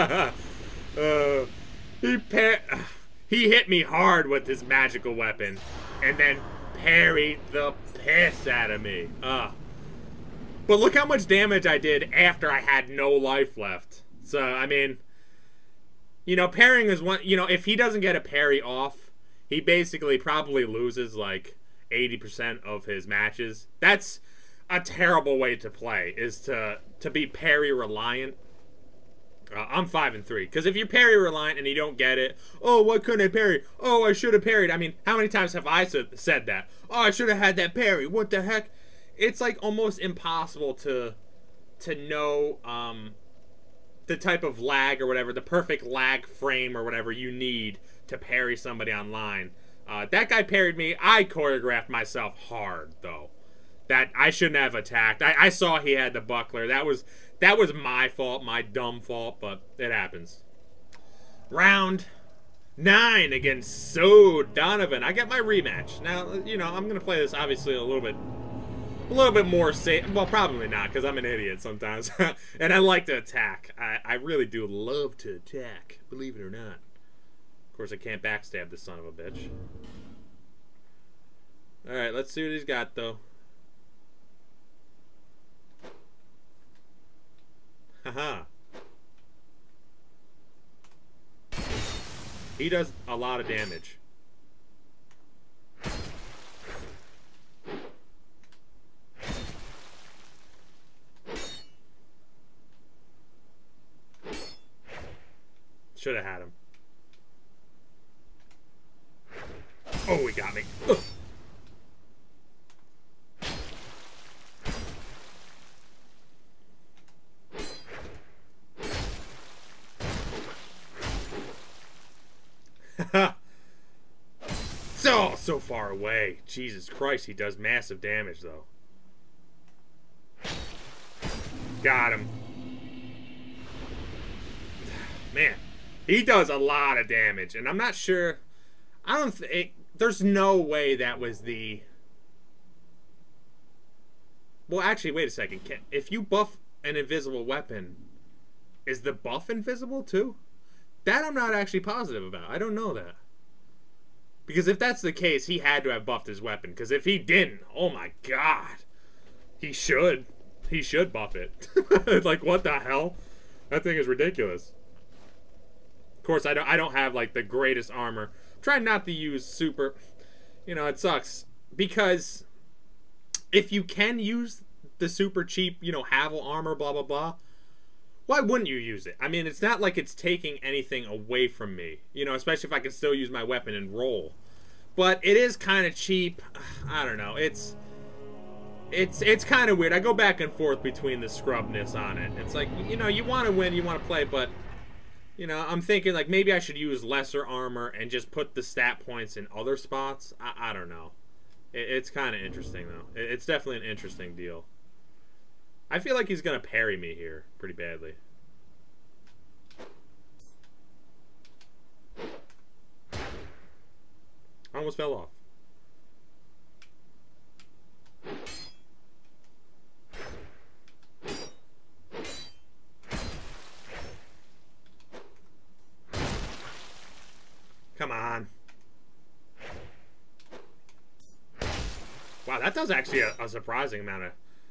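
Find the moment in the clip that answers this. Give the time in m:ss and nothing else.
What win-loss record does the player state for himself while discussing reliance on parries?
0:29.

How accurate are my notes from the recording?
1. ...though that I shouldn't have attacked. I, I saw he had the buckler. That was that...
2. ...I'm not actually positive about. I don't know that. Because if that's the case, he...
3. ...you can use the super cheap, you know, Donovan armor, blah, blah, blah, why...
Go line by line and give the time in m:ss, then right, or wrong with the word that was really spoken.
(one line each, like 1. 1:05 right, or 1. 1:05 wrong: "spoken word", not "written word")
1. 0:53 right
2. 2:31 right
3. 2:53 wrong: "Havel", not "Donovan".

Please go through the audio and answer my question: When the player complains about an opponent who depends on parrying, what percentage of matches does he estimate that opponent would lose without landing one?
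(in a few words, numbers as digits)
80%.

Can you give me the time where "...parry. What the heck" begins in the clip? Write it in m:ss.
0:37.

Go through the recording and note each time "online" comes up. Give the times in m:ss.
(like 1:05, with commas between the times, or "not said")
0:48.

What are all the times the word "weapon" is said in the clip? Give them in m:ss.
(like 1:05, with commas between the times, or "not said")
0:05, 2:27, 2:36, 3:03.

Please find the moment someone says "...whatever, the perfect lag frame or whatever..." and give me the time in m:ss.
0:45.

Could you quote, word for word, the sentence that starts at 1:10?
Well, probably not, because I'm an idiot sometimes.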